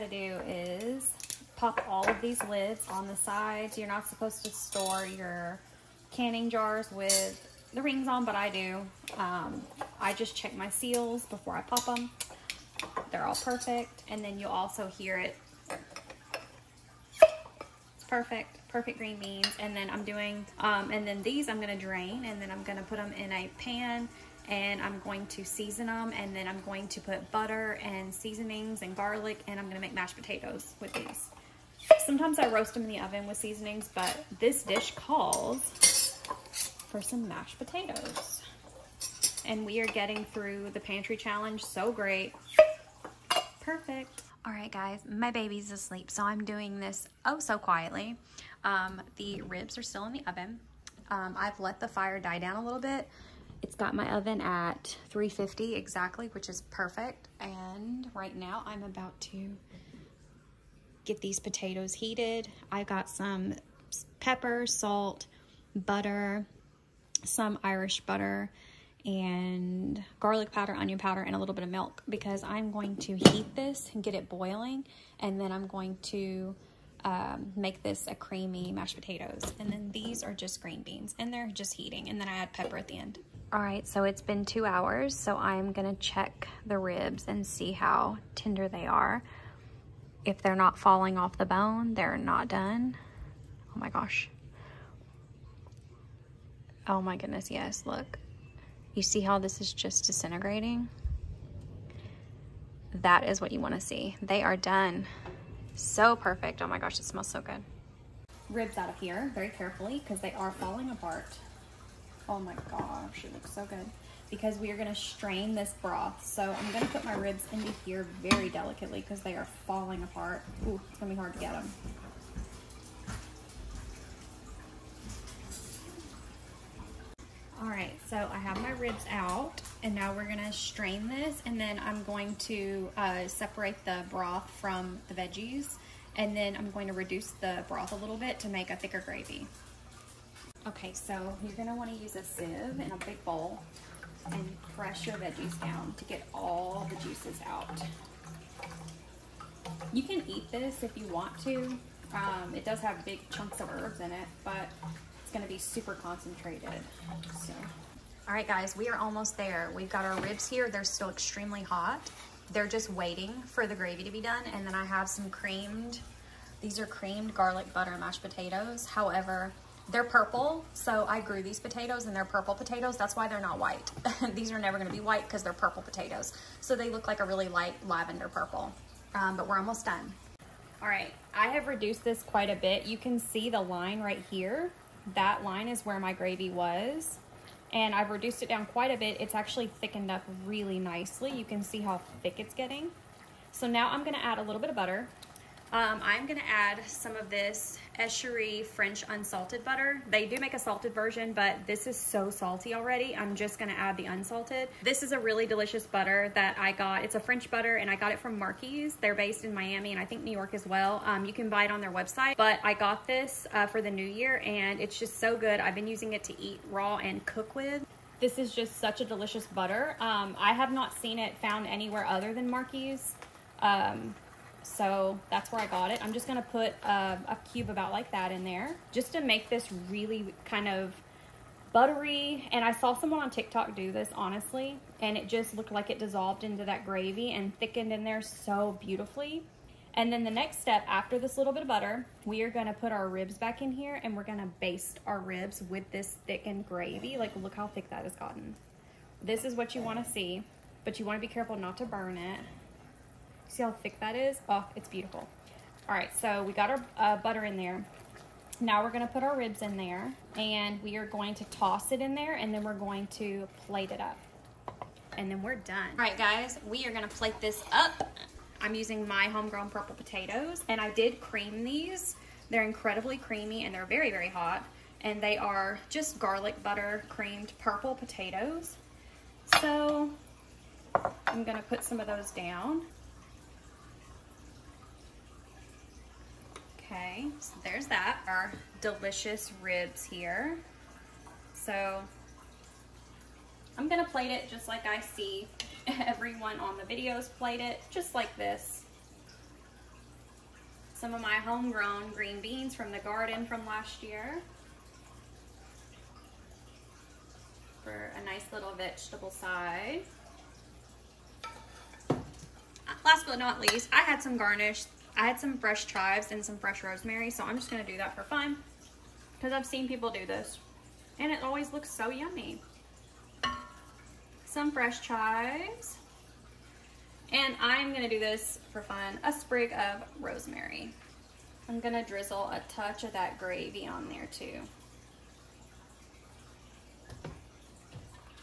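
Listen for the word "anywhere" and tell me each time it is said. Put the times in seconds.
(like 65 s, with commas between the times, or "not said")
221 s.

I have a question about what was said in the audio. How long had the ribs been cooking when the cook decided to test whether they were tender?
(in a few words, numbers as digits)
2 hours.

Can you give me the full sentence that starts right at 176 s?
So they look like a really light lavender purple.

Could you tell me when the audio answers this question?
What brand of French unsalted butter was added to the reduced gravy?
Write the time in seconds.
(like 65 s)
197 s.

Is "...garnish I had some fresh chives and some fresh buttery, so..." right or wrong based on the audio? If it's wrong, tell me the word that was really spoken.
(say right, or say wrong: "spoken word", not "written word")
wrong: "rosemary", not "buttery".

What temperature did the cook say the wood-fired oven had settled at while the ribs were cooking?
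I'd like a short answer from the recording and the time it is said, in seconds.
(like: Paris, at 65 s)
350, at 55 s.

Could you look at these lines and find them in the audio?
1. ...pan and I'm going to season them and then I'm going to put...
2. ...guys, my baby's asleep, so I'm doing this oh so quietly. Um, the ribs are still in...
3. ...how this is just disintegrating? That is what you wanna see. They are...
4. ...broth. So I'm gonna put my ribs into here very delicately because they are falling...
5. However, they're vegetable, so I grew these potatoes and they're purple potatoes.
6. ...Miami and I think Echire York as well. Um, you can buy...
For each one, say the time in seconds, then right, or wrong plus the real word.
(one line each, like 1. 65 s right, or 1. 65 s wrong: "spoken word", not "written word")
1. 23 s right
2. 44 s right
3. 99 s right
4. 115 s right
5. 168 s wrong: "purple", not "vegetable"
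6. 209 s wrong: "New", not "Echire".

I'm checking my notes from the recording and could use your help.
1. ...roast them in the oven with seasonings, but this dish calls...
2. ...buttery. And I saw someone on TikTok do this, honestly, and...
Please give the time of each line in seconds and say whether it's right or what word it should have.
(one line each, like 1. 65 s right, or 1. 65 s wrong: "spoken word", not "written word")
1. 32 s right
2. 231 s right.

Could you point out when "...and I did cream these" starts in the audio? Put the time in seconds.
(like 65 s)
270 s.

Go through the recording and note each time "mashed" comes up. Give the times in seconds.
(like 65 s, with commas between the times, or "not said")
29 s, 37 s, 78 s, 167 s.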